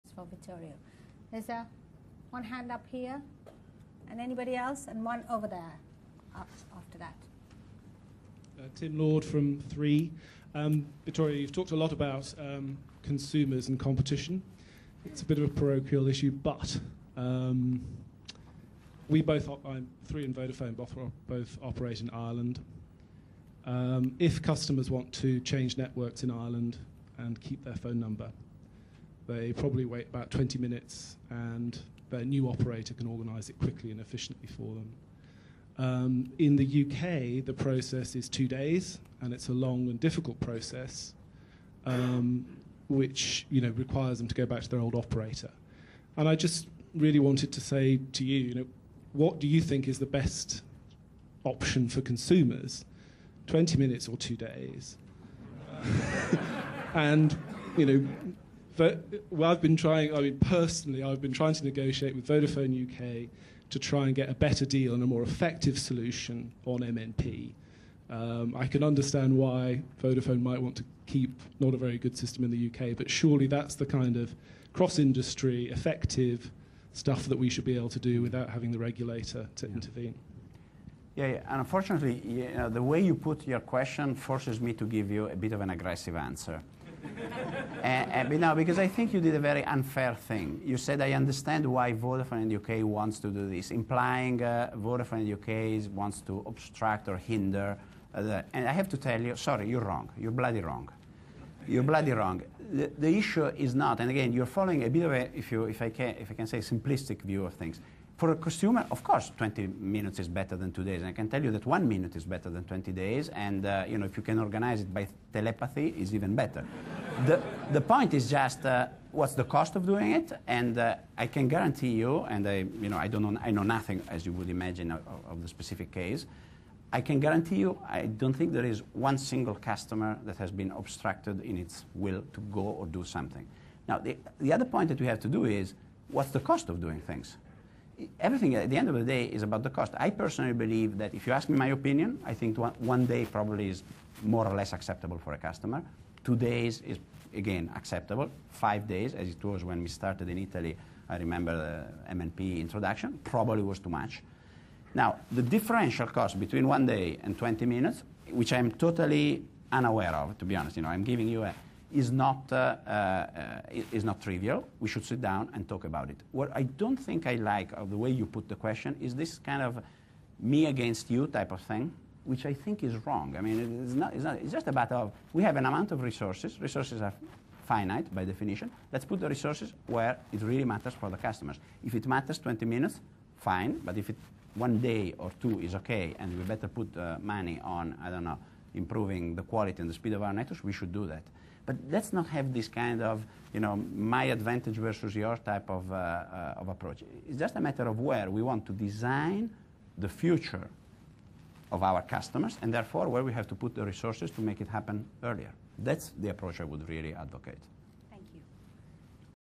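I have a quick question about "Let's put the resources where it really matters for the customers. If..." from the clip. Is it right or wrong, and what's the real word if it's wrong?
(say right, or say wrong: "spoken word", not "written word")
right.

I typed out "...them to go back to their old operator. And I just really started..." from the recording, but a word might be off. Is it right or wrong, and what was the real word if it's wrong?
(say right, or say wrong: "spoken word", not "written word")
wrong: "wanted", not "started".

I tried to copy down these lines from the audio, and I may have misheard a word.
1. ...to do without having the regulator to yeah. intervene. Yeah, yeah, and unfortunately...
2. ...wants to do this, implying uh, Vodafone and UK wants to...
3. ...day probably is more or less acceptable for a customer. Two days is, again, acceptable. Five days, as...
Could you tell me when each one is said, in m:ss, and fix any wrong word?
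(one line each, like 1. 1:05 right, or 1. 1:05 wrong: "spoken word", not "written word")
1. 1:17 right
2. 1:32 right
3. 2:23 right.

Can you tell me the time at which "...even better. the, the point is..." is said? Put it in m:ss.
1:56.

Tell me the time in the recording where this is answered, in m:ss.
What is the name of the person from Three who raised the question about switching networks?
0:08.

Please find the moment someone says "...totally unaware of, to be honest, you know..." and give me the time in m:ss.
2:38.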